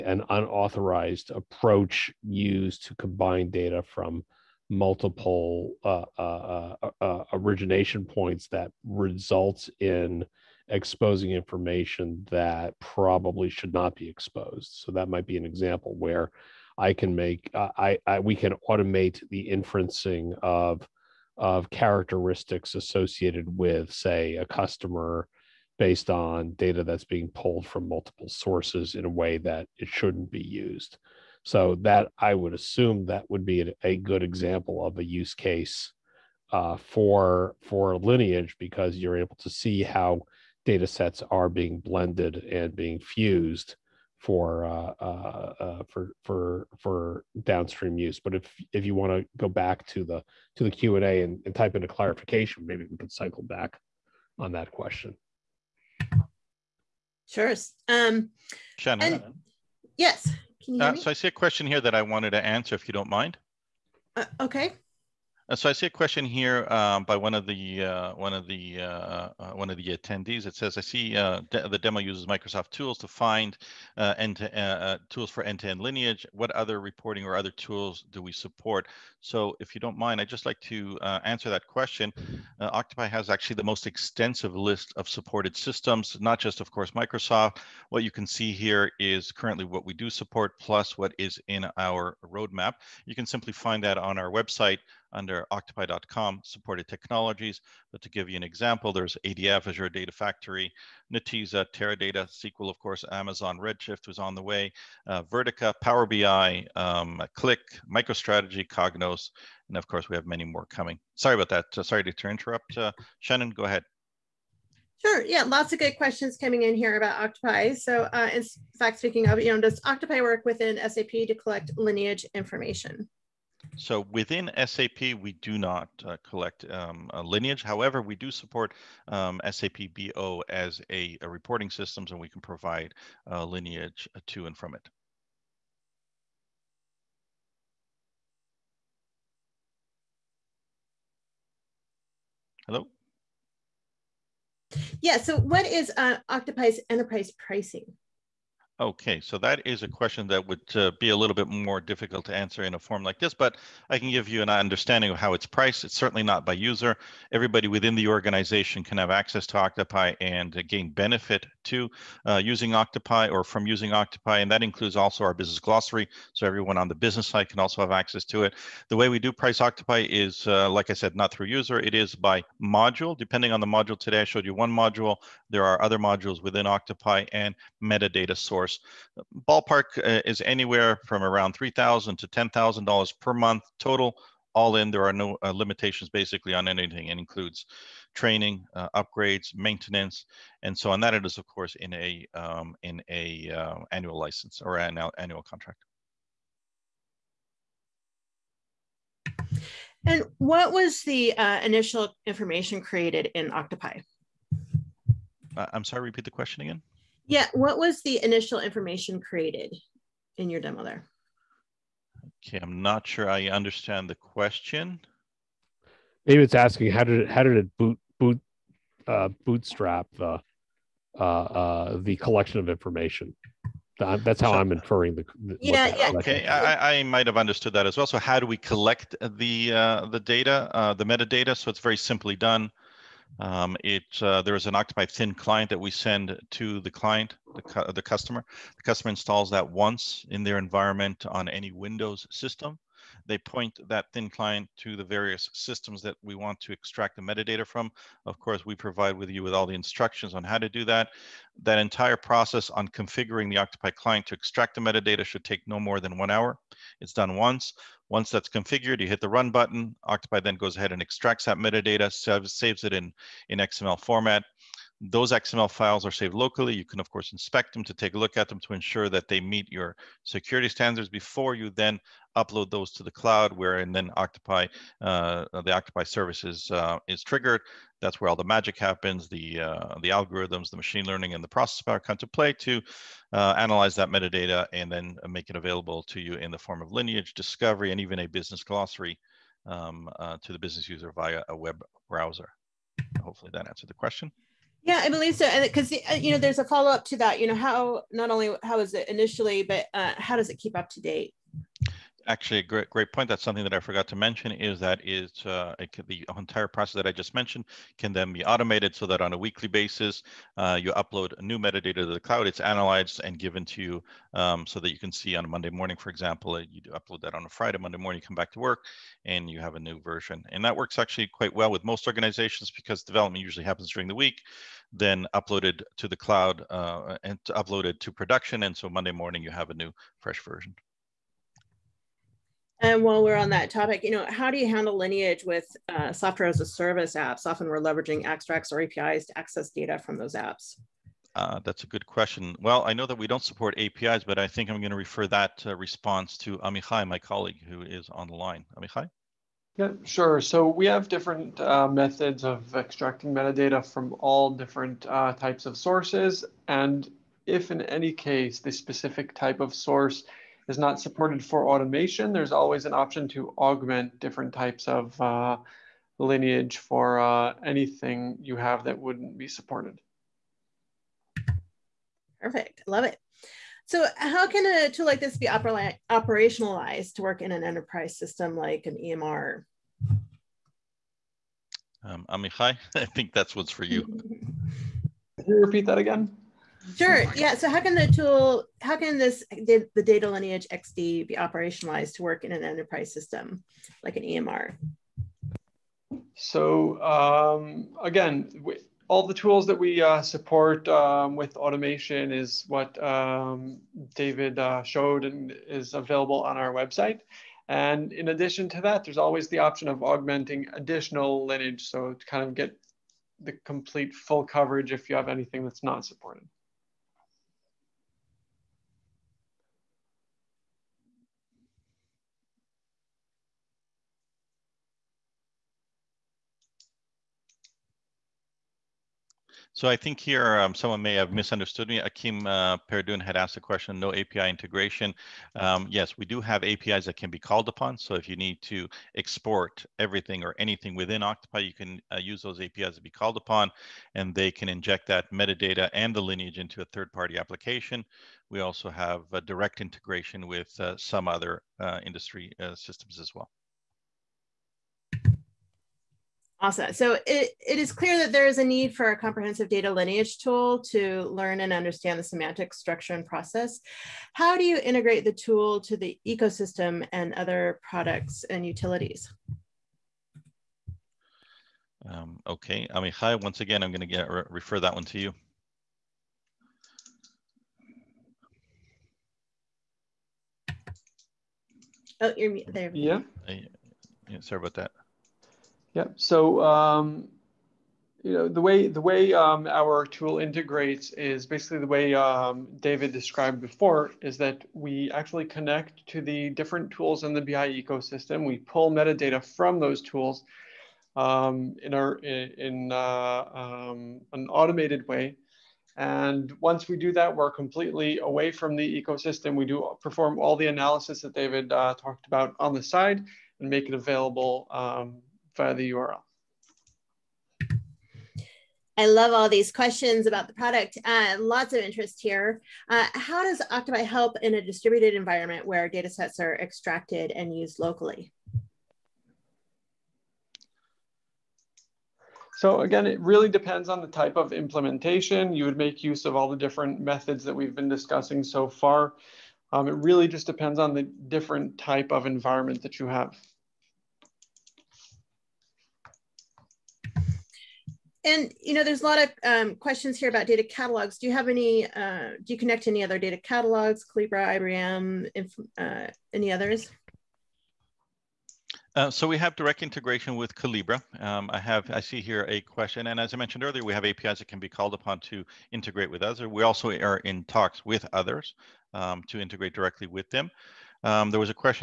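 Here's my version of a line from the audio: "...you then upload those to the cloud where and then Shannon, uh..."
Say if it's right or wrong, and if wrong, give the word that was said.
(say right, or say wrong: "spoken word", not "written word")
wrong: "Octopai", not "Shannon".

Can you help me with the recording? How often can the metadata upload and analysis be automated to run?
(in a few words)
weekly.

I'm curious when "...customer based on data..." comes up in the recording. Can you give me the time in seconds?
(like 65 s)
24 s.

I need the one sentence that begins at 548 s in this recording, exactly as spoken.
And you know, there's a lot of um, questions here about data catalogs.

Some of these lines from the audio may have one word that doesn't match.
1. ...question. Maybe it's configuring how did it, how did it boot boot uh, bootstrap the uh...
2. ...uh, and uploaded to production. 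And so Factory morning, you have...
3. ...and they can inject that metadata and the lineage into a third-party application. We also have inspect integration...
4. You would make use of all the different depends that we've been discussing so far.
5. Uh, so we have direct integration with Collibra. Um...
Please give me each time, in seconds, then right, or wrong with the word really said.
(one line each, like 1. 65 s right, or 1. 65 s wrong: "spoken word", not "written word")
1. 214 s wrong: "asking", not "configuring"
2. 326 s wrong: "Monday", not "Factory"
3. 444 s wrong: "direct", not "inspect"
4. 535 s wrong: "methods", not "depends"
5. 558 s right.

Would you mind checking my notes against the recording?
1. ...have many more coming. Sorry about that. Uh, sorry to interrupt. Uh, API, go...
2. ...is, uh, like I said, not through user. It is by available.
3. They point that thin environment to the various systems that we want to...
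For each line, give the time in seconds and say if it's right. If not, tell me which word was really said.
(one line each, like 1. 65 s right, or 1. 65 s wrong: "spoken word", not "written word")
1. 110 s wrong: "Shannon", not "API"
2. 170 s wrong: "module", not "available"
3. 243 s wrong: "client", not "environment".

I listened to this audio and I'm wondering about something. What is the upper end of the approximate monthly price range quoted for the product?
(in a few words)
$10,000.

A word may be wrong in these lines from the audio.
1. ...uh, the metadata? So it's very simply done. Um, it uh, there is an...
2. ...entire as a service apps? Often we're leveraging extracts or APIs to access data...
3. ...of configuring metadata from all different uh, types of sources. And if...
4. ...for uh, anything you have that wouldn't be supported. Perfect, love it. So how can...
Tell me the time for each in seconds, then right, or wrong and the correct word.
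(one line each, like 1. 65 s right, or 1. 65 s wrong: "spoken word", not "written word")
1. 230 s right
2. 336 s wrong: "software", not "entire"
3. 352 s wrong: "extracting", not "configuring"
4. 366 s right.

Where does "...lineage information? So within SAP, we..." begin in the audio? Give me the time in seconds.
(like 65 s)
121 s.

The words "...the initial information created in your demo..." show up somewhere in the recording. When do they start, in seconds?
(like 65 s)
208 s.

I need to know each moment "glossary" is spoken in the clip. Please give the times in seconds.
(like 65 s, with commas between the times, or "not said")
165 s, 288 s.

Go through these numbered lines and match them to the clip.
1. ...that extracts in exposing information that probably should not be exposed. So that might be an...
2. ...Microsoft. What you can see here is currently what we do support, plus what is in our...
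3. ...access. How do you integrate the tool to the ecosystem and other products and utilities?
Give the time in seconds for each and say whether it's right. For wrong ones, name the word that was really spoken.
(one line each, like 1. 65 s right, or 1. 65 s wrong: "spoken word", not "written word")
1. 8 s wrong: "results", not "extracts"
2. 86 s right
3. 463 s wrong: "process", not "access".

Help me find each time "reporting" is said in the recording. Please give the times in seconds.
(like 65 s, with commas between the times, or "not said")
76 s, 131 s.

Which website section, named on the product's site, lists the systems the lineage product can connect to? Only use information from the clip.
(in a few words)
supported technologies.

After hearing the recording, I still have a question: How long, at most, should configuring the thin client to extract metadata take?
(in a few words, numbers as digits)
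one hour.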